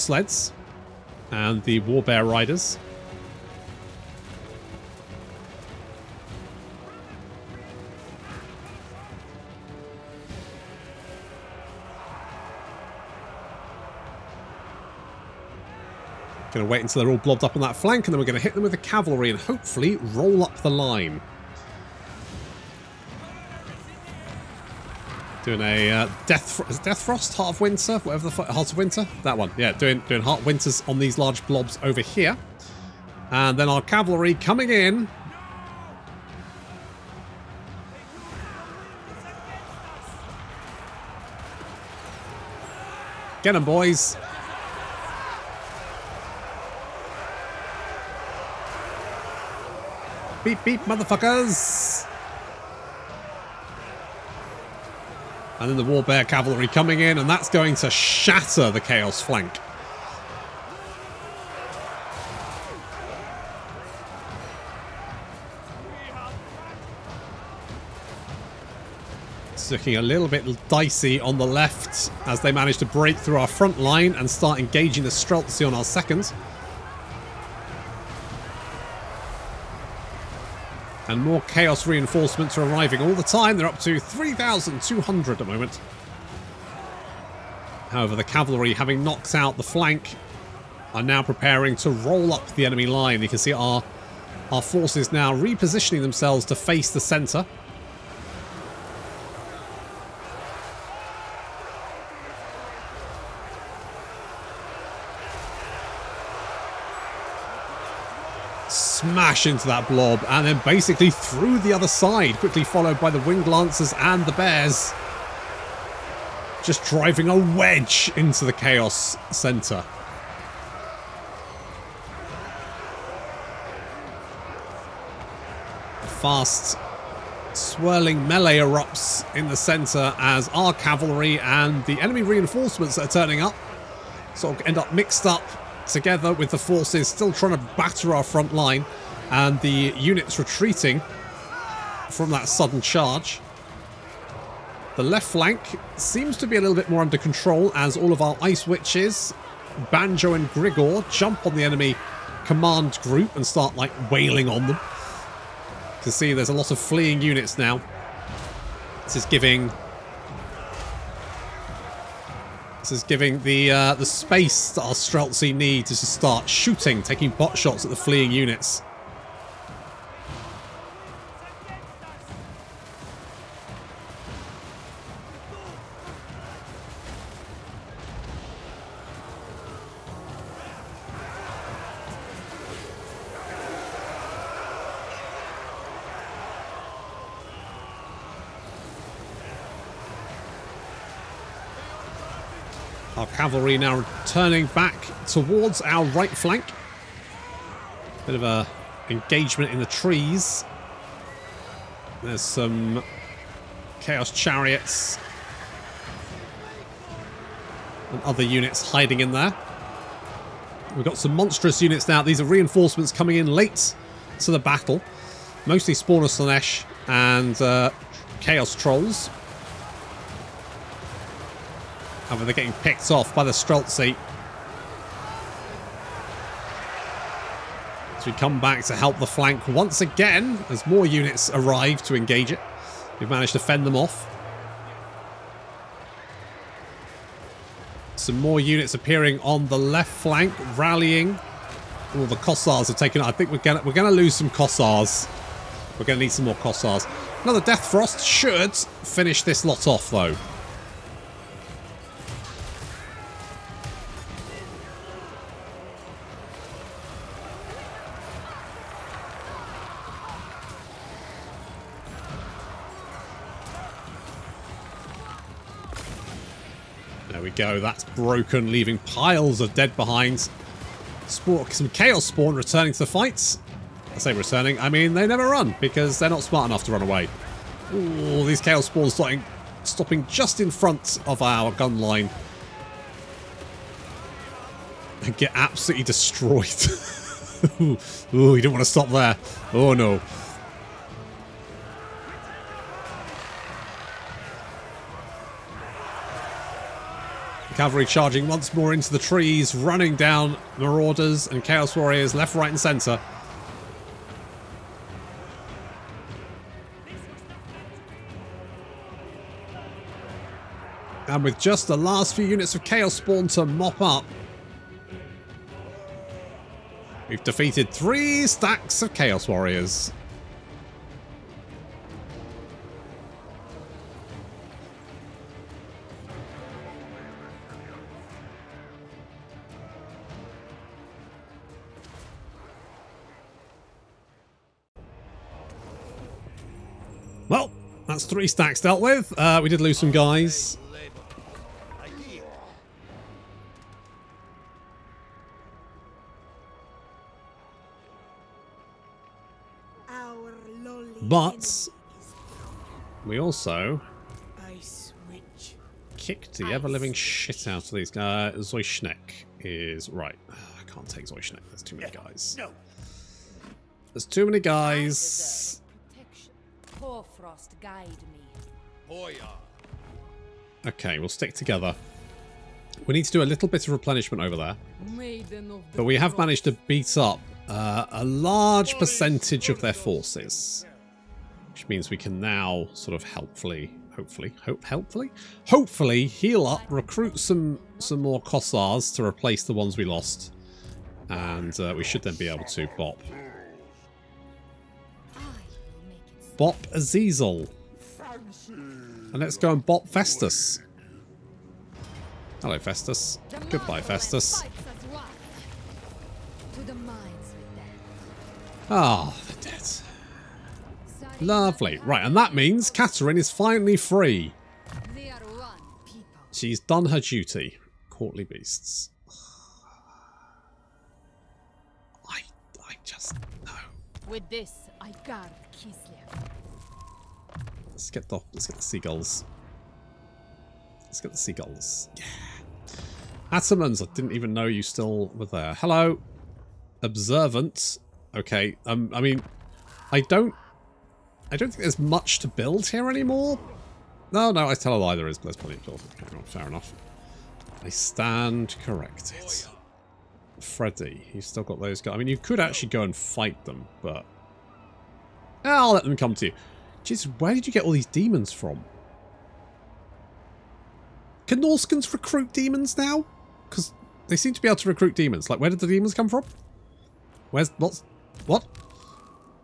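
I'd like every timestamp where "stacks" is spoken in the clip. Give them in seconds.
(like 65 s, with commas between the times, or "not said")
318 s, 338 s.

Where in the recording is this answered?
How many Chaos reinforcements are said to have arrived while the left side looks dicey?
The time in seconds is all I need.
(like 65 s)
83 s.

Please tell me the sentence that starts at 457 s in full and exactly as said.
Jesus, where did you get all these demons from?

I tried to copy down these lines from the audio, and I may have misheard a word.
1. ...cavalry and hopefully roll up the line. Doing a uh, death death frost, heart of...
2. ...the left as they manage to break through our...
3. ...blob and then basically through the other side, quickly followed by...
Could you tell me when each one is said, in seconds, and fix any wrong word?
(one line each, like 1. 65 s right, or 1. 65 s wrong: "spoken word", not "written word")
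1. 18 s right
2. 71 s right
3. 109 s right.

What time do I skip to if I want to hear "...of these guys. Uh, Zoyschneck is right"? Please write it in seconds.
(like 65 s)
357 s.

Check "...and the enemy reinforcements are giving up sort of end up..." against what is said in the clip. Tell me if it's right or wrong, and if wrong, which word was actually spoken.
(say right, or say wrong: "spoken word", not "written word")
wrong: "turning", not "giving".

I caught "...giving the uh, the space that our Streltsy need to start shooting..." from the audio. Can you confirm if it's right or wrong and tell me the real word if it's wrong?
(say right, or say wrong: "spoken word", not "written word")
right.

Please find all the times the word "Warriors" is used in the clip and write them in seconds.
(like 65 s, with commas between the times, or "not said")
301 s, 319 s.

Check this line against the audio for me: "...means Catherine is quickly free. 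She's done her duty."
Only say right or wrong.
wrong.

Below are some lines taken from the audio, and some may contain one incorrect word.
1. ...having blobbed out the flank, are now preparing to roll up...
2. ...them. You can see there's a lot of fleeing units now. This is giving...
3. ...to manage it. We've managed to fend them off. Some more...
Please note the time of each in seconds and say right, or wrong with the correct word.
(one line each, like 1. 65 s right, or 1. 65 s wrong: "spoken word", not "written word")
1. 88 s wrong: "knocked", not "blobbed"
2. 154 s right
3. 232 s wrong: "engage", not "manage".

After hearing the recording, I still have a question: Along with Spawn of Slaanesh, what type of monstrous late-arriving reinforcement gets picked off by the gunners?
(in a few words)
Chaos Trolls.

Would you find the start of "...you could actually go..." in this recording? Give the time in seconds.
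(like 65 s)
452 s.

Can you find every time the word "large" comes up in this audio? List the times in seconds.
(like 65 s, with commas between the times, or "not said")
31 s, 378 s.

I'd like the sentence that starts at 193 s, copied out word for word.
cavalry now turning back towards our right flank.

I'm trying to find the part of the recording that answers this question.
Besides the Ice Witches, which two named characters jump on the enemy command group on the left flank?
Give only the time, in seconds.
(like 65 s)
149 s.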